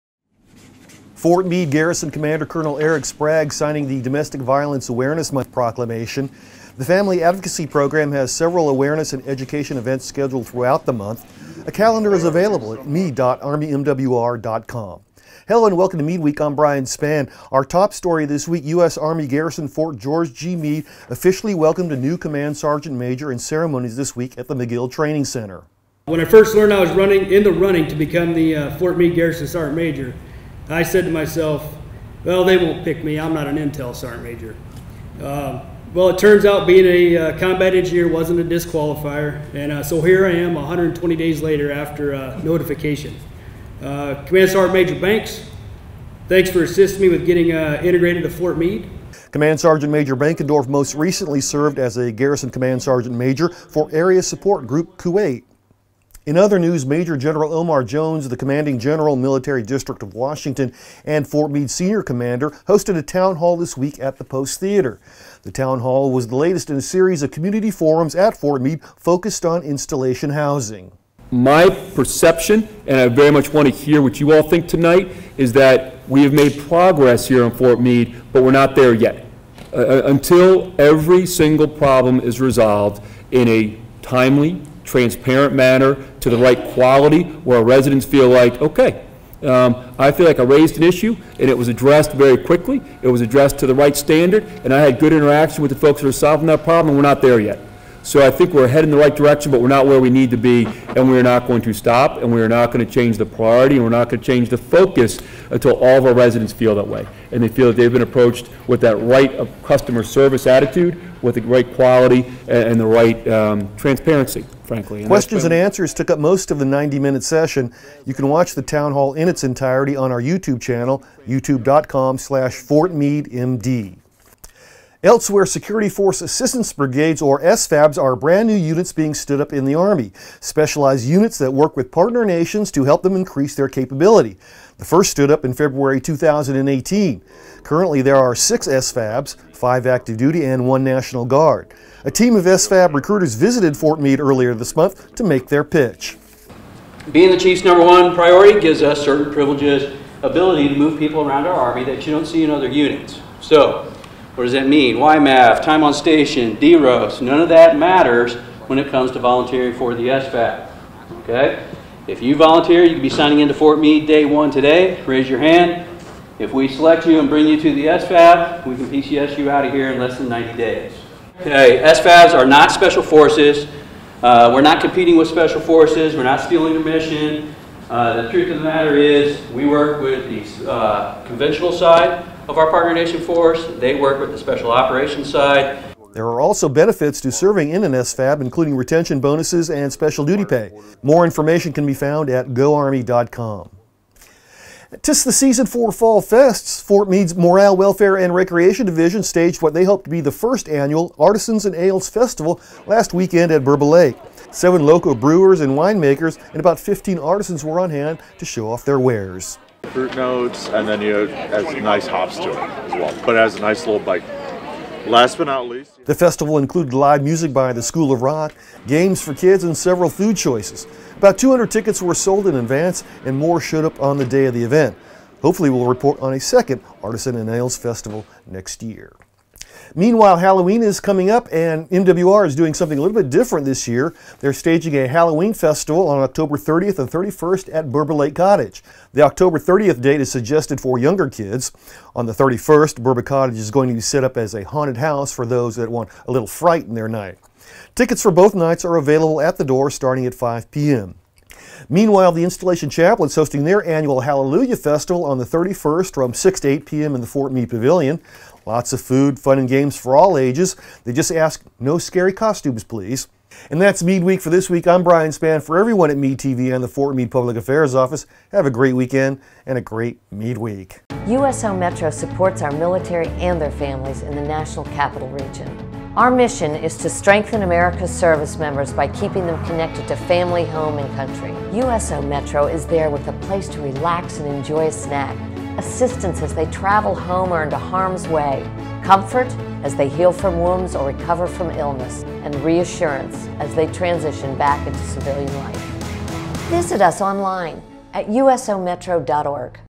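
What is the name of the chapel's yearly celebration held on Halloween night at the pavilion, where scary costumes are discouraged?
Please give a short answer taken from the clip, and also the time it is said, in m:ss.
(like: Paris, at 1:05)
Hallelujah Festival, at 4:14.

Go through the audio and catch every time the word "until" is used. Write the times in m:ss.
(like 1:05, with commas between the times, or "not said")
1:20, 1:45.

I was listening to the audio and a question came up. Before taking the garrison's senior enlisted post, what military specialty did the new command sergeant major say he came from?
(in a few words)
Combat engineer.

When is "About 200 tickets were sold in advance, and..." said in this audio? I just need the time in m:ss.
3:41.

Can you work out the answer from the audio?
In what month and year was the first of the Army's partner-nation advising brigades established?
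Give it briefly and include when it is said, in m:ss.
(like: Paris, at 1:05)
February 2018, at 2:15.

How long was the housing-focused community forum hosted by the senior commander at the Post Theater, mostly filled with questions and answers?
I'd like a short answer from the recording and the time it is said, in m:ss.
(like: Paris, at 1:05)
90 minutes, at 1:56.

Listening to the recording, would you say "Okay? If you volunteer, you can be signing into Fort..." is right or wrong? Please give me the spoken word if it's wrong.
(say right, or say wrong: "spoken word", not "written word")
right.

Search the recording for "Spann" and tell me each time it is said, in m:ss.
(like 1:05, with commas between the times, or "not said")
0:16, 4:25.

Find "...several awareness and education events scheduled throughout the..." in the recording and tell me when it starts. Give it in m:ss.
0:08.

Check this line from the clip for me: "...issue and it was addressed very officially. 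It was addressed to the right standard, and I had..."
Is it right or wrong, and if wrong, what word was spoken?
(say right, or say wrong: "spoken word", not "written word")
wrong: "quickly", not "officially".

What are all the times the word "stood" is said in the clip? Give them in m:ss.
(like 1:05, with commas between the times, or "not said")
2:09, 2:15.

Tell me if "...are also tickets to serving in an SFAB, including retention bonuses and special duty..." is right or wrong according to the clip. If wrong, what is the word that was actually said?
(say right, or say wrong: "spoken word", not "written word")
wrong: "benefits", not "tickets".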